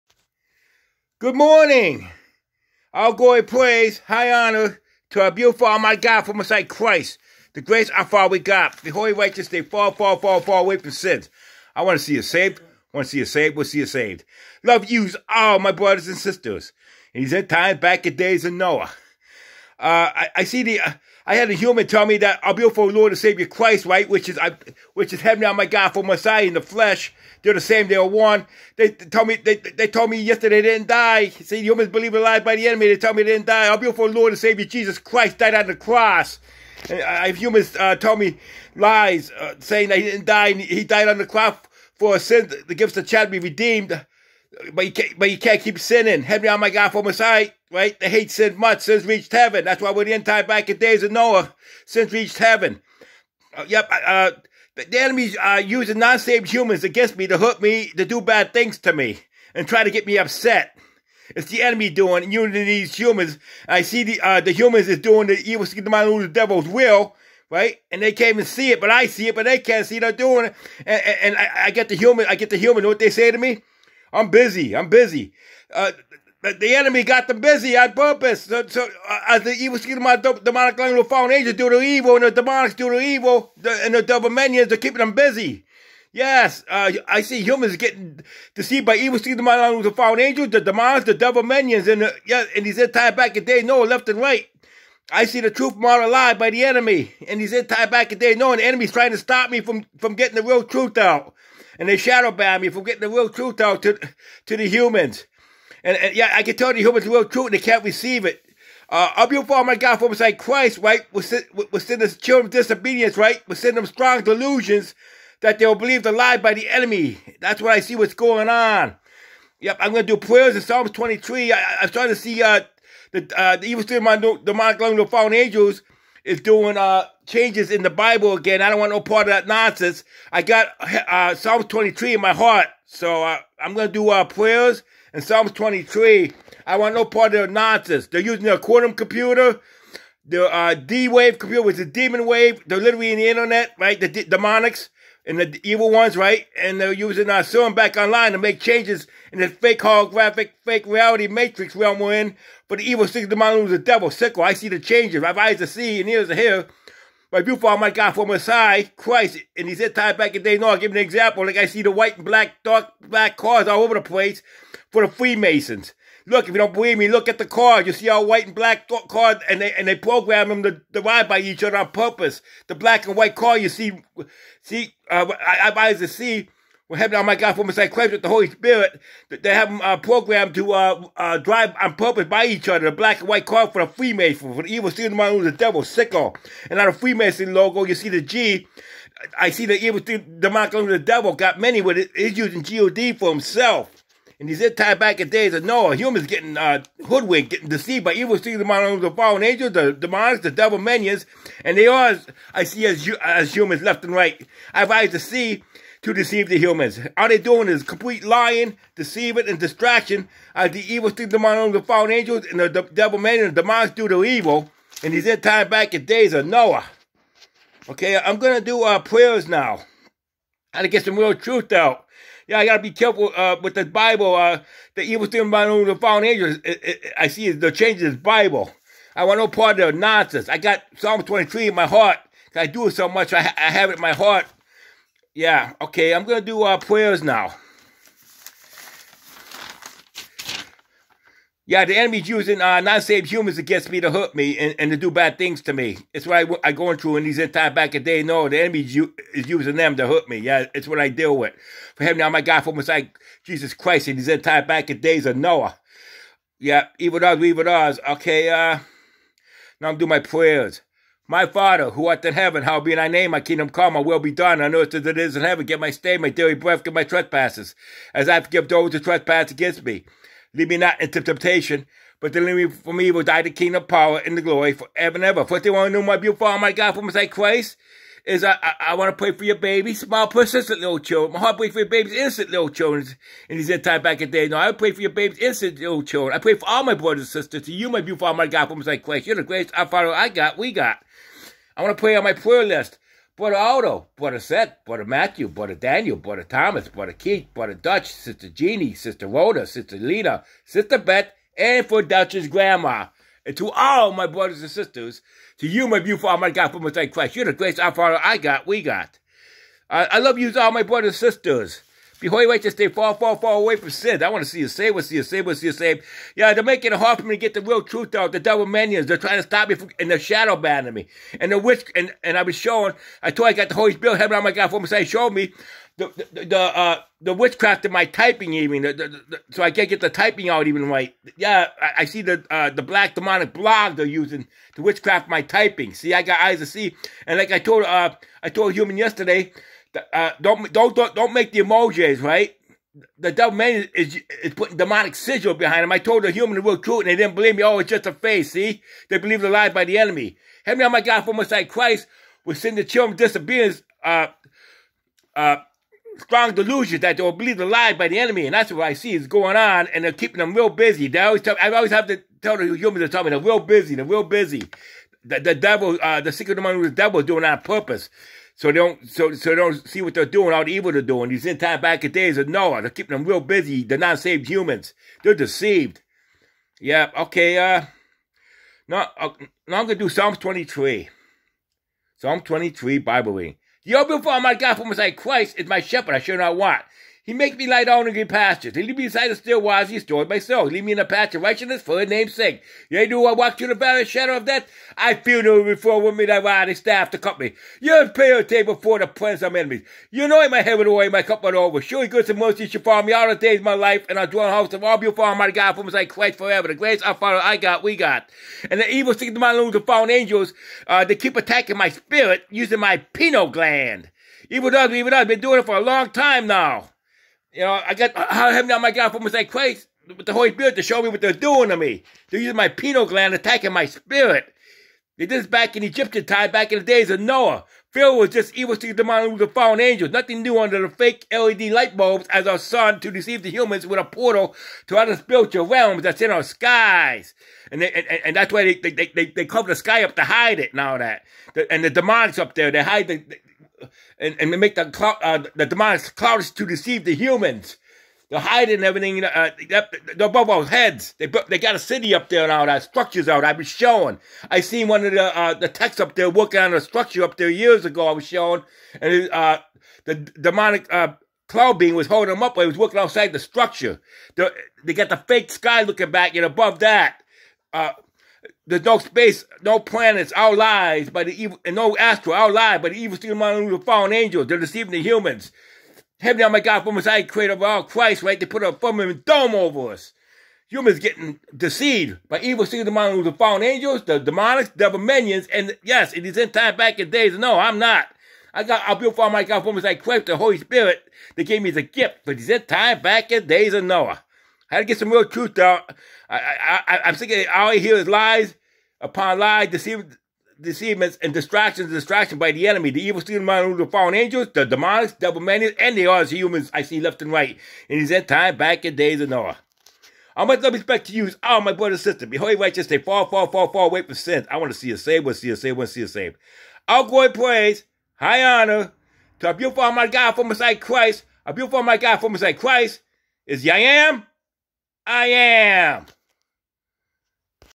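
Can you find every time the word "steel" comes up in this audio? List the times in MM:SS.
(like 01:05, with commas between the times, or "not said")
07:53, 08:02.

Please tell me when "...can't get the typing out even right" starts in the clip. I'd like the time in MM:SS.
05:29.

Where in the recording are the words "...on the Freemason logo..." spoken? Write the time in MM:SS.
03:06.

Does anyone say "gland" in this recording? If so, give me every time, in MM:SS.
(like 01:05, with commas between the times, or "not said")
06:53, 07:03.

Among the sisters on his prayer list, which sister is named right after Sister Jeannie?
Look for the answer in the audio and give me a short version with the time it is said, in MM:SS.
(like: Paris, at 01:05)
Sister Rhoda, at 04:58.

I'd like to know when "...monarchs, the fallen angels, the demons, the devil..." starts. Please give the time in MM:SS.
03:18.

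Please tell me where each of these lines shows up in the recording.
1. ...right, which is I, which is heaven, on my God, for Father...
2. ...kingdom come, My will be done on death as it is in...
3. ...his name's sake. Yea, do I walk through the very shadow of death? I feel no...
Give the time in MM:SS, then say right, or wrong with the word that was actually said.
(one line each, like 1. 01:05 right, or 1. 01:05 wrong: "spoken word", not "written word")
1. 00:23 wrong: "Messiah", not "Father"
2. 04:23 wrong: "earth", not "death"
3. 06:31 right.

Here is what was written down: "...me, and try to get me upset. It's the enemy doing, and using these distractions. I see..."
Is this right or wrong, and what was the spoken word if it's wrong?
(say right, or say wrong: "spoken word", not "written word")
wrong: "humans", not "distractions".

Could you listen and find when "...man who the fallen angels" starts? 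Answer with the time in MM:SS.
07:09.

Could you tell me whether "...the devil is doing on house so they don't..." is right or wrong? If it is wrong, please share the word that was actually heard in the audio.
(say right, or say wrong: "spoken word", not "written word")
wrong: "purpose", not "house".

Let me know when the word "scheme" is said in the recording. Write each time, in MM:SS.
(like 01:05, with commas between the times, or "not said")
01:19, 01:29.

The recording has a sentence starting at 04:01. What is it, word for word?
Yeah, the enemy's using uh, non-saved humans against me to hurt me and, and to do bad things to me.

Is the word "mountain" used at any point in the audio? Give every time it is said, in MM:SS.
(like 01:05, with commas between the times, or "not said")
07:53, 08:02.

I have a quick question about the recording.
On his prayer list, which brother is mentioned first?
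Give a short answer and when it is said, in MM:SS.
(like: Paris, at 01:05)
Brother Otto, at 04:53.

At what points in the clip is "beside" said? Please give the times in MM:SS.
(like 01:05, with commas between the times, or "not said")
01:50, 06:29.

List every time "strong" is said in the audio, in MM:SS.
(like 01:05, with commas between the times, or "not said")
01:53, 05:56.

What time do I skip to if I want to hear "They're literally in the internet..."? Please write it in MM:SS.
02:22.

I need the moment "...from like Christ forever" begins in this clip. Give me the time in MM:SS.
06:45.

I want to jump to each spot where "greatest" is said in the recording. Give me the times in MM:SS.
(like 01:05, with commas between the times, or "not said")
04:49, 05:07.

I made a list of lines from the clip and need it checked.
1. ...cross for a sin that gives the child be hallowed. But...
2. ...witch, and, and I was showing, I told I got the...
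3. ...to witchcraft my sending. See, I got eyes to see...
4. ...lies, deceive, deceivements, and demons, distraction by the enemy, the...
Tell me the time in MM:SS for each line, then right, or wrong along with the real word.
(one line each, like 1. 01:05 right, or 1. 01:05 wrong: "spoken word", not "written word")
1. 00:41 wrong: "redeemed", not "hallowed"
2. 05:21 right
3. 05:34 wrong: "typing", not "sending"
4. 08:19 wrong: "distractions", not "demons".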